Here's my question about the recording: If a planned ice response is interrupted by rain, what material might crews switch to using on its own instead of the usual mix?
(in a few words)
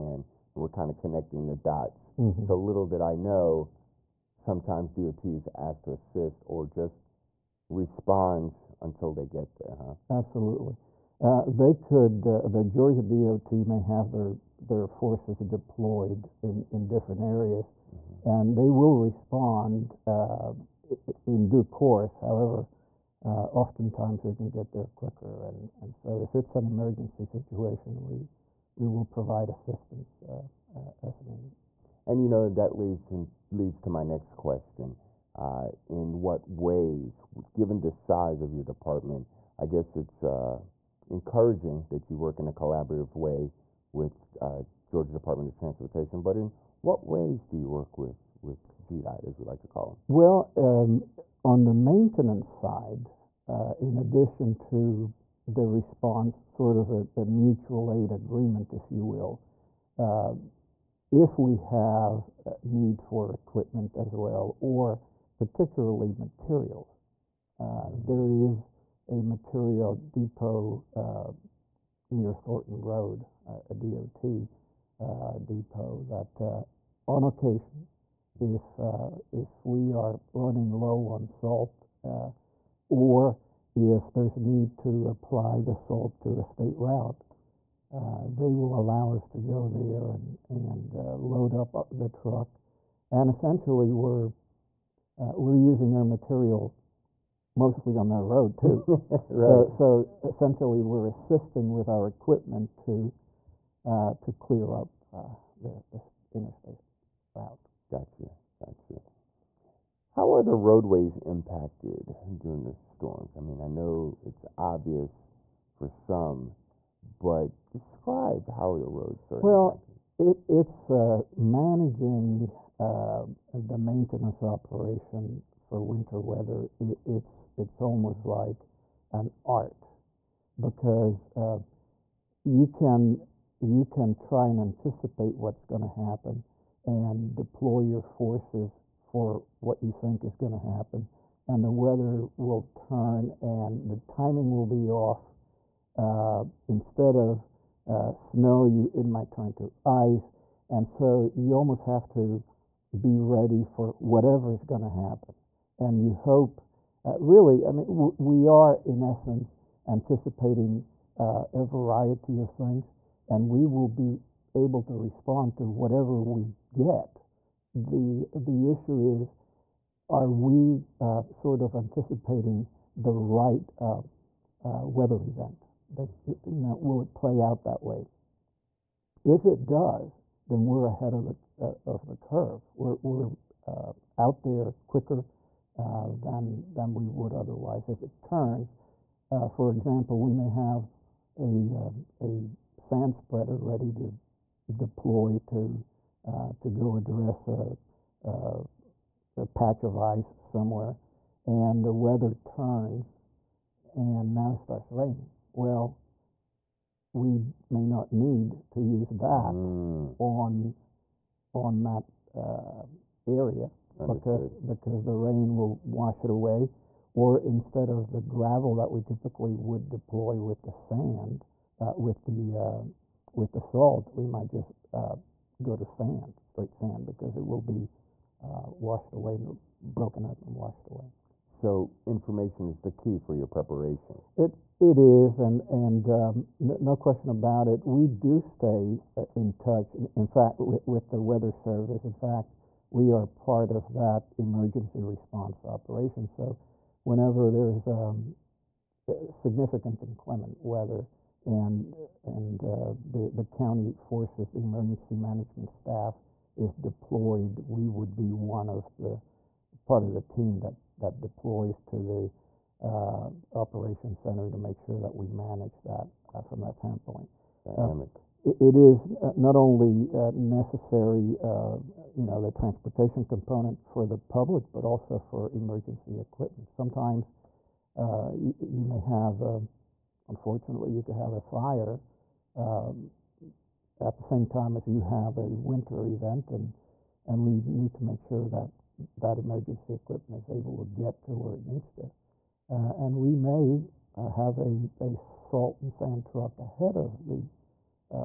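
Straight sand.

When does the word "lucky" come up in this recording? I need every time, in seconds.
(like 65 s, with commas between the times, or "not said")
not said.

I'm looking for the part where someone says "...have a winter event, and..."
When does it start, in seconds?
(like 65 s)
285 s.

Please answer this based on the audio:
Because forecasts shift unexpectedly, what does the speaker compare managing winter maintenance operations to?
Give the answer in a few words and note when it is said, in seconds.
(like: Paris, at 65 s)
An art, at 129 s.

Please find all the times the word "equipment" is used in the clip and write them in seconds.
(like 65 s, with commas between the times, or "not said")
63 s, 102 s, 276 s, 289 s.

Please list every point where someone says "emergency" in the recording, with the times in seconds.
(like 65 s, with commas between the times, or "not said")
26 s, 244 s, 254 s, 275 s, 289 s.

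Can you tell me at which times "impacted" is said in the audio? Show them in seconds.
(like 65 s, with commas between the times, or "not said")
111 s, 119 s.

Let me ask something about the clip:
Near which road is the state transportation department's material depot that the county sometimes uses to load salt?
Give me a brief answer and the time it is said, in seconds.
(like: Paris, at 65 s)
Thornton Road, at 72 s.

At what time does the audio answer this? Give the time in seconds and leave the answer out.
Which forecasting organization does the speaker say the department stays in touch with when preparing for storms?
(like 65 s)
241 s.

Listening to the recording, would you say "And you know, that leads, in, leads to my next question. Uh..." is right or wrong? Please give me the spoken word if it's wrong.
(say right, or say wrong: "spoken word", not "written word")
right.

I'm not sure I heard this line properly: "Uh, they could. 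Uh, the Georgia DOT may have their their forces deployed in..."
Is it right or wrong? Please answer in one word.
right.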